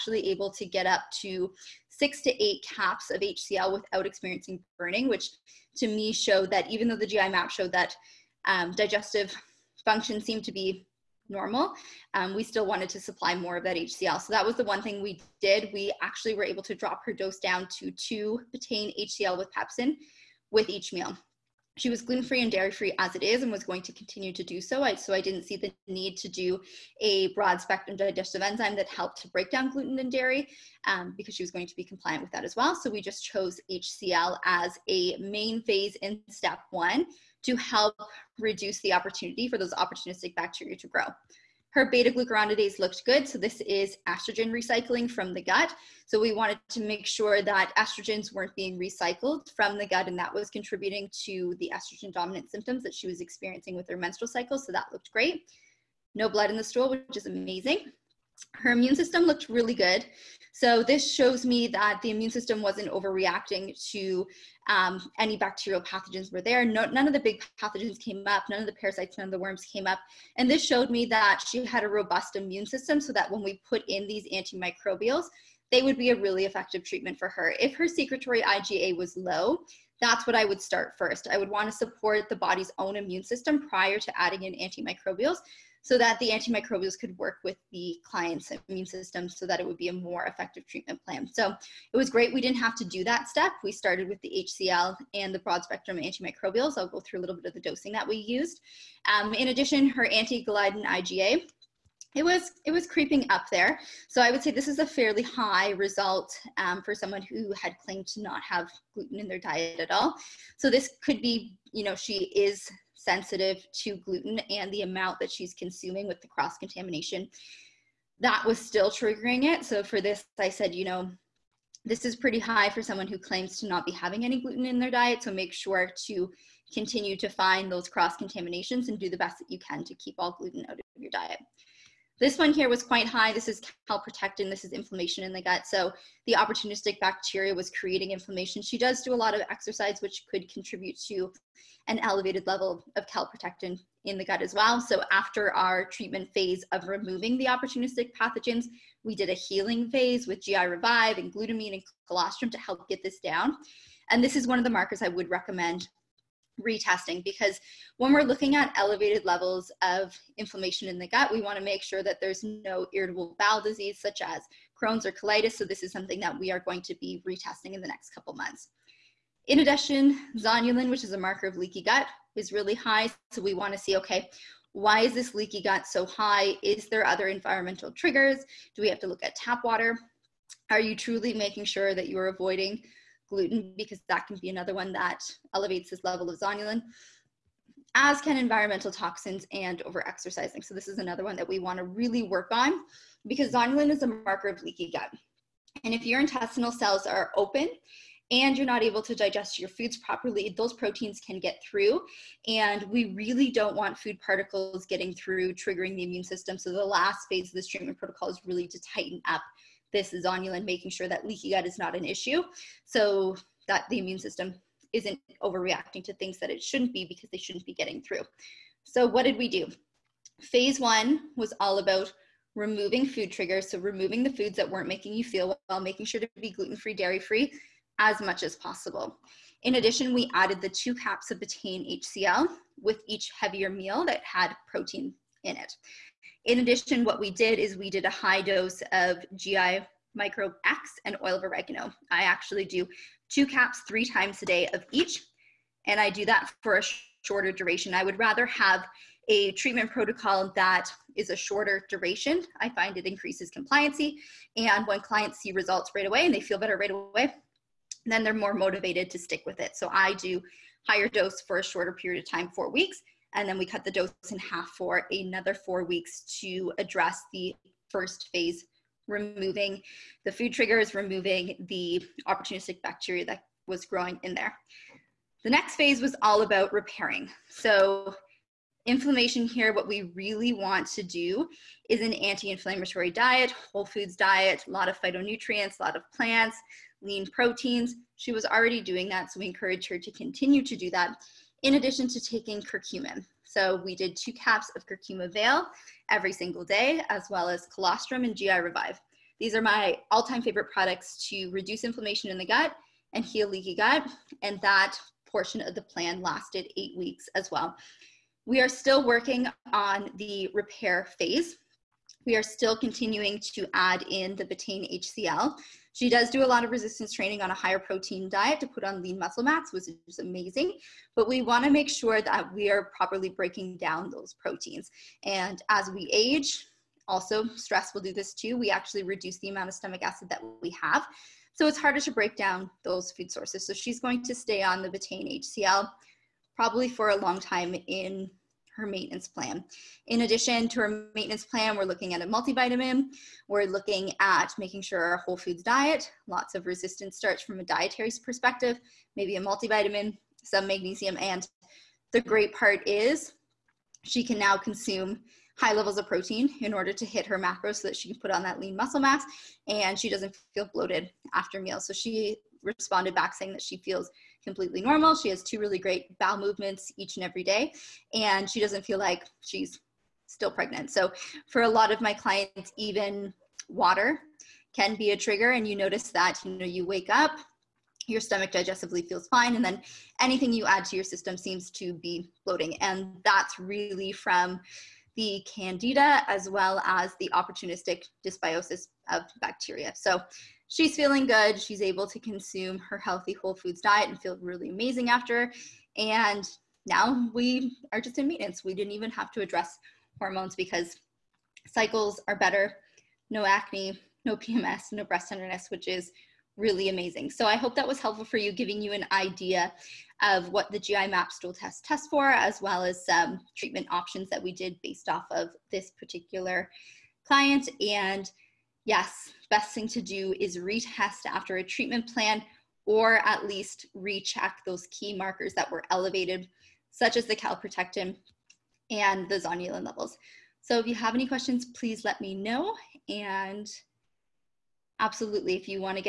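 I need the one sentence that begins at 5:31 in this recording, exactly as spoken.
So it's harder to break down those food sources.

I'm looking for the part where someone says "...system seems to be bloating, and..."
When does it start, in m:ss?
6:21.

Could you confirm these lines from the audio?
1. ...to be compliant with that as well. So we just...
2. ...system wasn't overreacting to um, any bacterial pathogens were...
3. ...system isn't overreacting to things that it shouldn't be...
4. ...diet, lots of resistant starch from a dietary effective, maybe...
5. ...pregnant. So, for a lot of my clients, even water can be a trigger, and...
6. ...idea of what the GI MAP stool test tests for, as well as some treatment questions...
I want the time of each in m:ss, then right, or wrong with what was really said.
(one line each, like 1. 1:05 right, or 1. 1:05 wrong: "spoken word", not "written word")
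1. 0:31 right
2. 1:02 right
3. 3:34 right
4. 5:45 wrong: "perspective", not "effective"
5. 6:10 right
6. 6:49 wrong: "options", not "questions".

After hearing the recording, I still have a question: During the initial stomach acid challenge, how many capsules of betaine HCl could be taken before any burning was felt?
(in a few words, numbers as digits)
6 to 8.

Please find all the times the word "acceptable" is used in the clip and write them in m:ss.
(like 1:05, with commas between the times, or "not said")
not said.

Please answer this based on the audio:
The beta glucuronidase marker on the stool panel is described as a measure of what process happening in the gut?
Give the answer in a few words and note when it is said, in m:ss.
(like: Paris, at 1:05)
Estrogen recycling, at 0:44.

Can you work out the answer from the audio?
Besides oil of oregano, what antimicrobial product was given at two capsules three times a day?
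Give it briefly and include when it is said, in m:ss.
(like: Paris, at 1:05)
GI Microbe X, at 3:59.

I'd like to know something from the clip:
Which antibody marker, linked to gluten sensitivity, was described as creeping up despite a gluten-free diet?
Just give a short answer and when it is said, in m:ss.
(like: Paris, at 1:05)
Anti-gliadin IgA, at 1:40.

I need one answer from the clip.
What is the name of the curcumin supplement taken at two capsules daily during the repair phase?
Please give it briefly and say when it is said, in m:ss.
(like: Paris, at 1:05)
Curcum-Evail, at 4:54.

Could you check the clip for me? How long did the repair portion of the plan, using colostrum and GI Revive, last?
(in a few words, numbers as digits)
8 weeks.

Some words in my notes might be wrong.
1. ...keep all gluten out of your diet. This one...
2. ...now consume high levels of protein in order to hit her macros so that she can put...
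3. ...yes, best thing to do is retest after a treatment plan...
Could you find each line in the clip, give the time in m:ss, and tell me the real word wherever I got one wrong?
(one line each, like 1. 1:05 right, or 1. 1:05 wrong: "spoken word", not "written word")
1. 2:09 right
2. 5:54 right
3. 6:58 right.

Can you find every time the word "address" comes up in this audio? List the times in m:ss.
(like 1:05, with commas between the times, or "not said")
4:26, 6:39.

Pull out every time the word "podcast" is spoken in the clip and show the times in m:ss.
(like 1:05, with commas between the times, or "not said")
not said.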